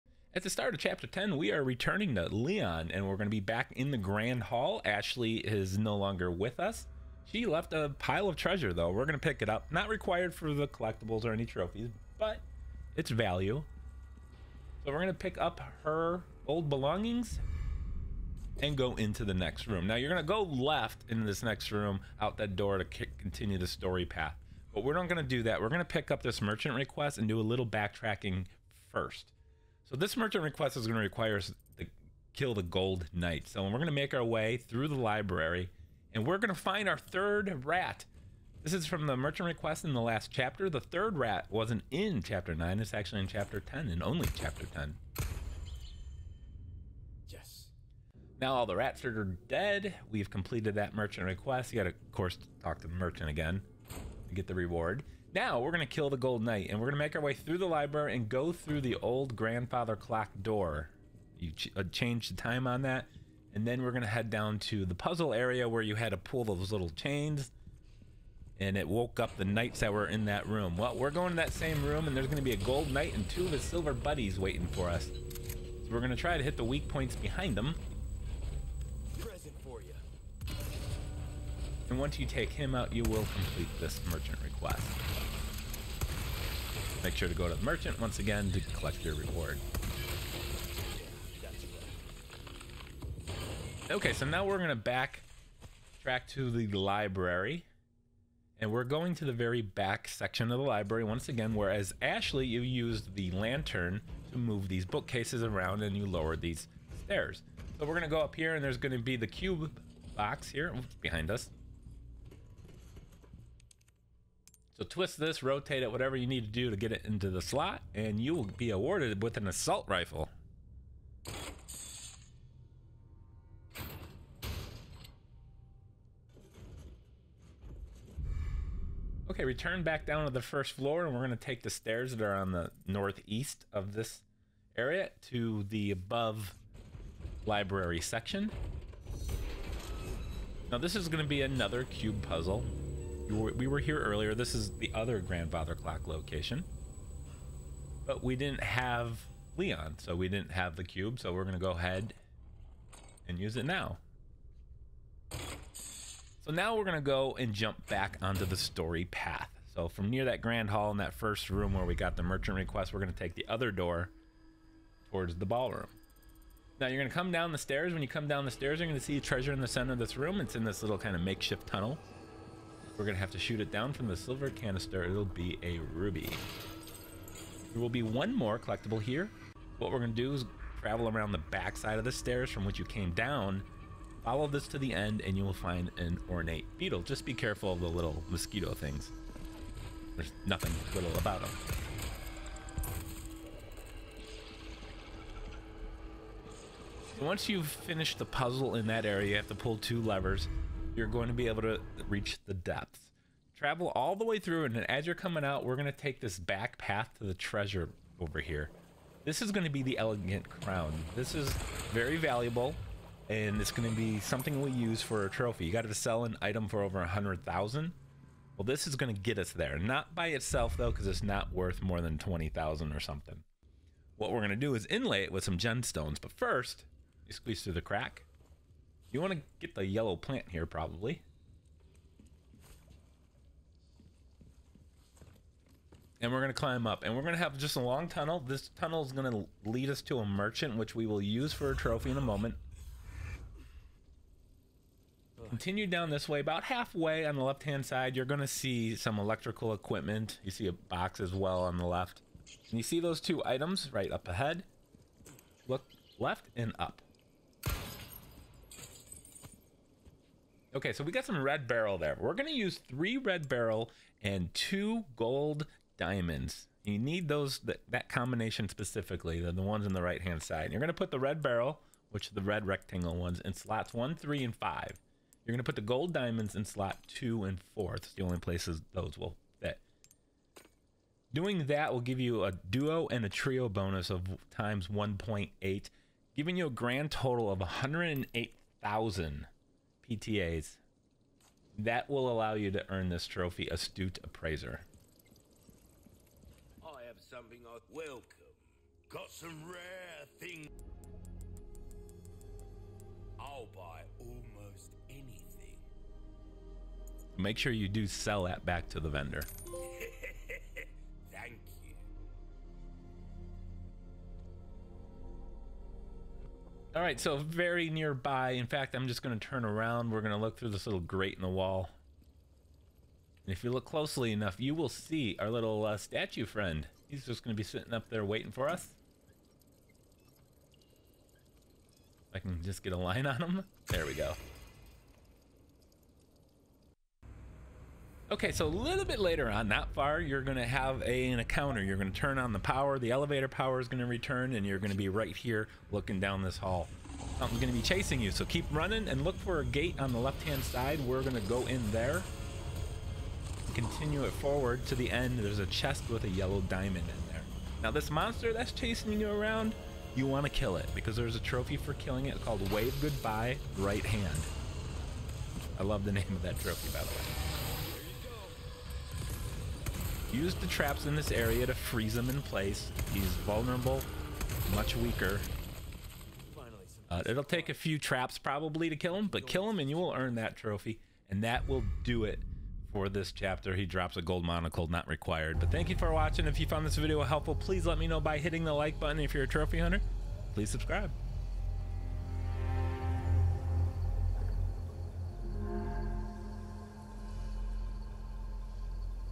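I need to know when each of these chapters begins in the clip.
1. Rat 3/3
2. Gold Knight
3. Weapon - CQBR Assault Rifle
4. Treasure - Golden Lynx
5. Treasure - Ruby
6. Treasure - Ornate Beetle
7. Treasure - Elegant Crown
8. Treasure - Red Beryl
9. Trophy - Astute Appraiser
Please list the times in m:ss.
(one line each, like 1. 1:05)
1. 0:28
2. 0:48
3. 1:36
4. 2:10
5. 2:43
6. 2:59
7. 3:22
8. 3:43
9. 4:21.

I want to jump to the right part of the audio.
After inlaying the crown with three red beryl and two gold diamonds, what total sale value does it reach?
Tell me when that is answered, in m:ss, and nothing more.
4:47.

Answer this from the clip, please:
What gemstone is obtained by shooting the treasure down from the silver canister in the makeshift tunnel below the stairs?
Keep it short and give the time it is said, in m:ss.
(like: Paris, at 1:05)
Ruby, at 2:55.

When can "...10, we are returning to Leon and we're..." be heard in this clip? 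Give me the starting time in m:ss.
0:01.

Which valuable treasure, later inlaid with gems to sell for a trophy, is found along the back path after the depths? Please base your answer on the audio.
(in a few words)
Elegant Crown.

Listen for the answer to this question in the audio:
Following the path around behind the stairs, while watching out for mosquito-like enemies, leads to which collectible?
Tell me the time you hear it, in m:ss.
3:06.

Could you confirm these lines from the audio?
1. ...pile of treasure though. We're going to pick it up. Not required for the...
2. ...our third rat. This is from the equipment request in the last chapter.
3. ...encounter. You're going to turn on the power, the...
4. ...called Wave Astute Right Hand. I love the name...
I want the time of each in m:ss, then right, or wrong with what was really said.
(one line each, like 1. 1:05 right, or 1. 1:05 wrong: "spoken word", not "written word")
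1. 0:07 right
2. 0:36 wrong: "merchant", not "equipment"
3. 5:41 right
4. 6:02 wrong: "Goodbye", not "Astute".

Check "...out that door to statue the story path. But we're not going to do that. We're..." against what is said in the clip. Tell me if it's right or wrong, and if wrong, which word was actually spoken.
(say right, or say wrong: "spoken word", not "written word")
wrong: "continue", not "statue".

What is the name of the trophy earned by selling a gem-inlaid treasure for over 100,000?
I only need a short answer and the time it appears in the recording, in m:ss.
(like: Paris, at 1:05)
Astute Appraiser, at 4:53.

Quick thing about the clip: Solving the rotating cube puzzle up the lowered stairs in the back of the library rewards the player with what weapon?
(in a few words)
Assault rifle.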